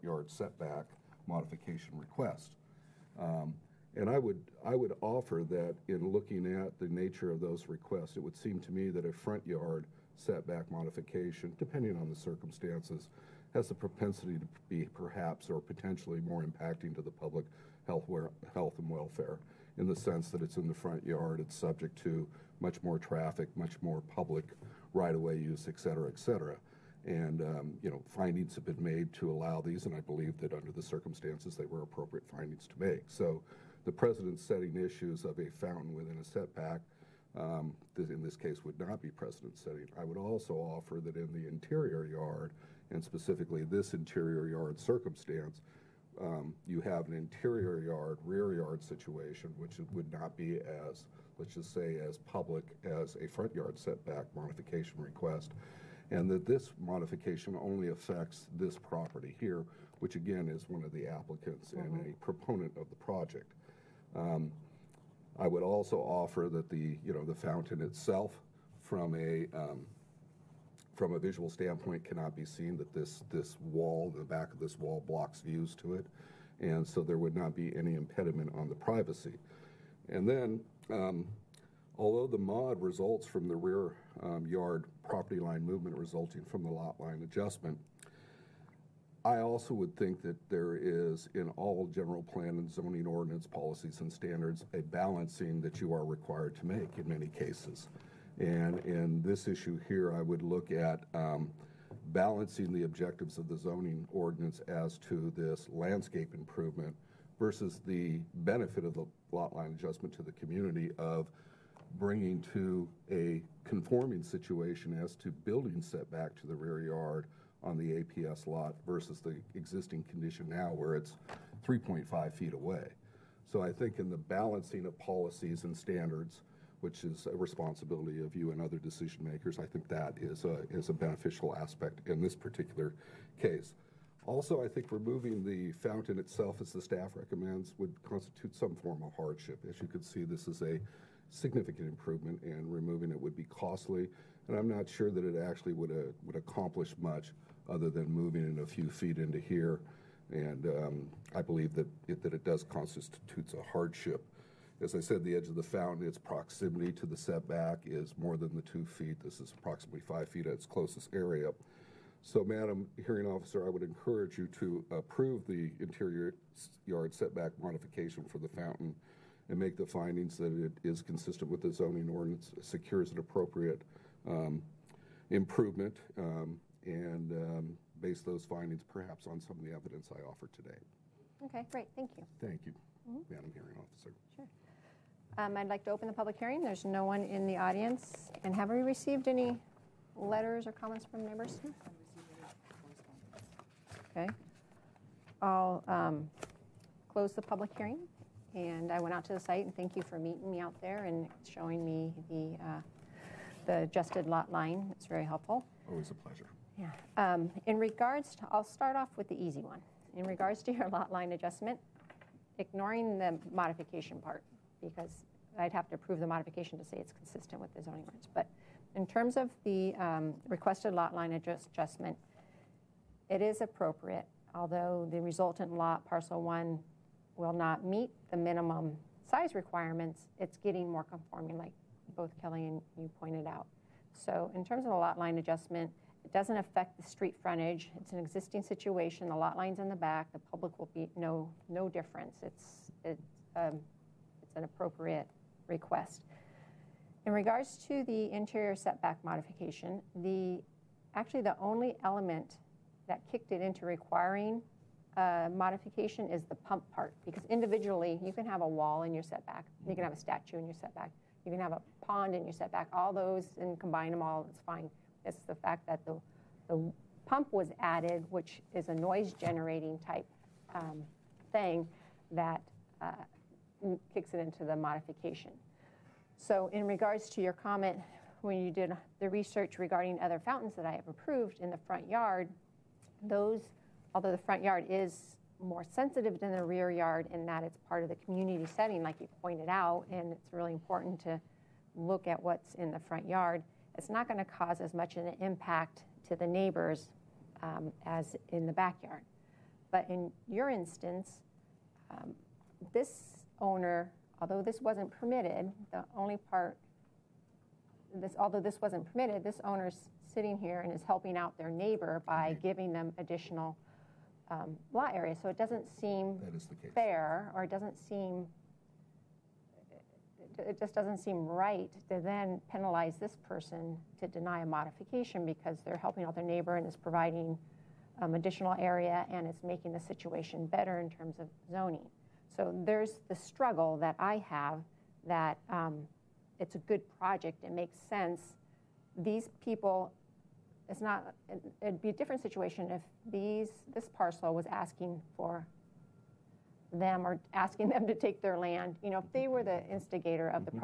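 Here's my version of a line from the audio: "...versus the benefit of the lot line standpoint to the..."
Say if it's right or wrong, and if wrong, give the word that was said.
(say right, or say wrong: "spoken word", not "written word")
wrong: "adjustment", not "standpoint".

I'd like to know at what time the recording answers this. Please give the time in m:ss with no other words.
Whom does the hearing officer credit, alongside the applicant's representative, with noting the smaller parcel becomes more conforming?
3:52.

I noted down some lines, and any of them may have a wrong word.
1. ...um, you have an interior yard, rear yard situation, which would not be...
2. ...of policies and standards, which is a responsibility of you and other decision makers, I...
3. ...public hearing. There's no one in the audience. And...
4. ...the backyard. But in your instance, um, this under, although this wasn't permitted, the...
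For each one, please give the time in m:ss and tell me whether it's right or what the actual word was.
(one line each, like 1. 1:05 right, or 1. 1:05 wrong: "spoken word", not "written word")
1. 0:46 right
2. 2:04 right
3. 3:06 right
4. 4:58 wrong: "owner", not "under".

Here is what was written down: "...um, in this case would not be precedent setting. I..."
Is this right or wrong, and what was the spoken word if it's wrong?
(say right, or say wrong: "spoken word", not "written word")
right.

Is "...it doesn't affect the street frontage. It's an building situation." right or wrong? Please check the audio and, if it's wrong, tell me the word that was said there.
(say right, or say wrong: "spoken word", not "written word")
wrong: "existing", not "building".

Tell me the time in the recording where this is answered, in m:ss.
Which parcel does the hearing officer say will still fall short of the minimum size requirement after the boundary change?
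3:46.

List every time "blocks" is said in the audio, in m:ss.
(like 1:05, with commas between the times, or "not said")
1:15.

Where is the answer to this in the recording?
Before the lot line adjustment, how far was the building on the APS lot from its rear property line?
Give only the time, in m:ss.
2:01.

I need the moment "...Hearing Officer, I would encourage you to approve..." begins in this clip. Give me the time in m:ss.
2:43.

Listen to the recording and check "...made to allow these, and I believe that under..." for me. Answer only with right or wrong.
right.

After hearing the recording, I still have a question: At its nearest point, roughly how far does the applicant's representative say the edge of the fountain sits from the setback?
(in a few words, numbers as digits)
5 feet.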